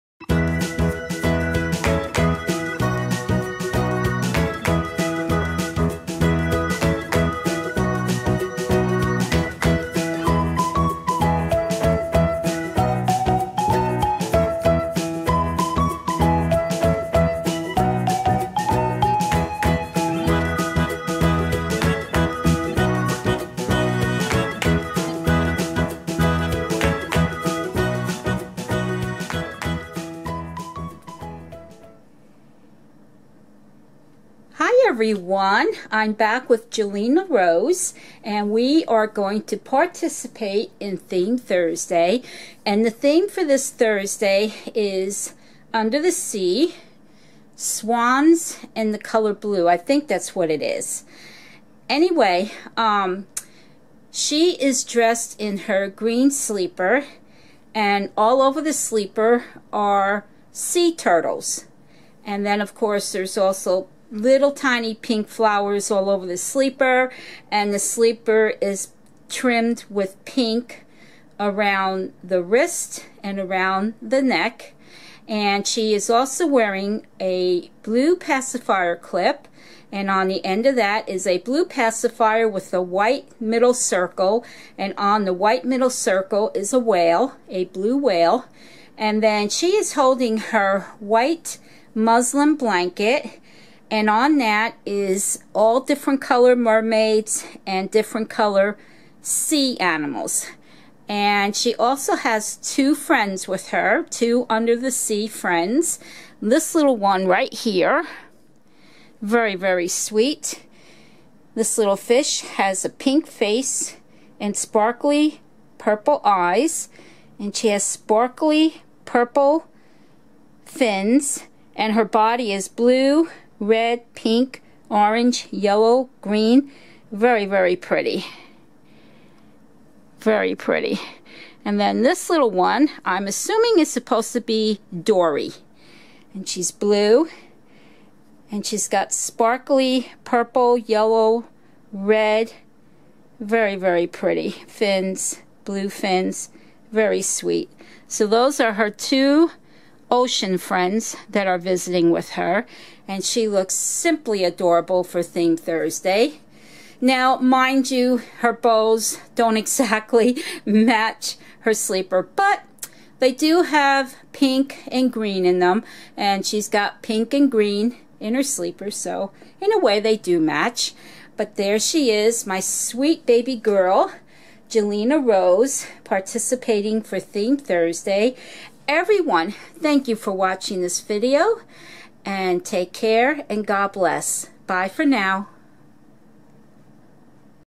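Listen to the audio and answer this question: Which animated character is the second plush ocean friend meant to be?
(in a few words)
Dory.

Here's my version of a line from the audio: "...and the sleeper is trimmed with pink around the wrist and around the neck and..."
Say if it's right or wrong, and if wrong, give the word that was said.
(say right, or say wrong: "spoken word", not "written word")
right.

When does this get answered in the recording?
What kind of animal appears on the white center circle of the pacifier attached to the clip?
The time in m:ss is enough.
1:27.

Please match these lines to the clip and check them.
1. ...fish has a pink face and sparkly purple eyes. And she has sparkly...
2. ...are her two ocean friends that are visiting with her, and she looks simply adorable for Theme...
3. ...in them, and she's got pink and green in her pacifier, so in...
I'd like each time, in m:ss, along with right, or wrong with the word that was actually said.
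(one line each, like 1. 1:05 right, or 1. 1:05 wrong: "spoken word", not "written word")
1. 1:51 right
2. 2:28 right
3. 2:45 wrong: "sleeper", not "pacifier".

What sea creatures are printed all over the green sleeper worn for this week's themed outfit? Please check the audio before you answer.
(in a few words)
Sea turtles.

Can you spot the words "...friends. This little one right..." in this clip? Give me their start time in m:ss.
1:45.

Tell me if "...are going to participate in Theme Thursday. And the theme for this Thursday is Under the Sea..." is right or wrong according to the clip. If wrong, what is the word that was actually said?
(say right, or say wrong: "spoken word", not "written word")
right.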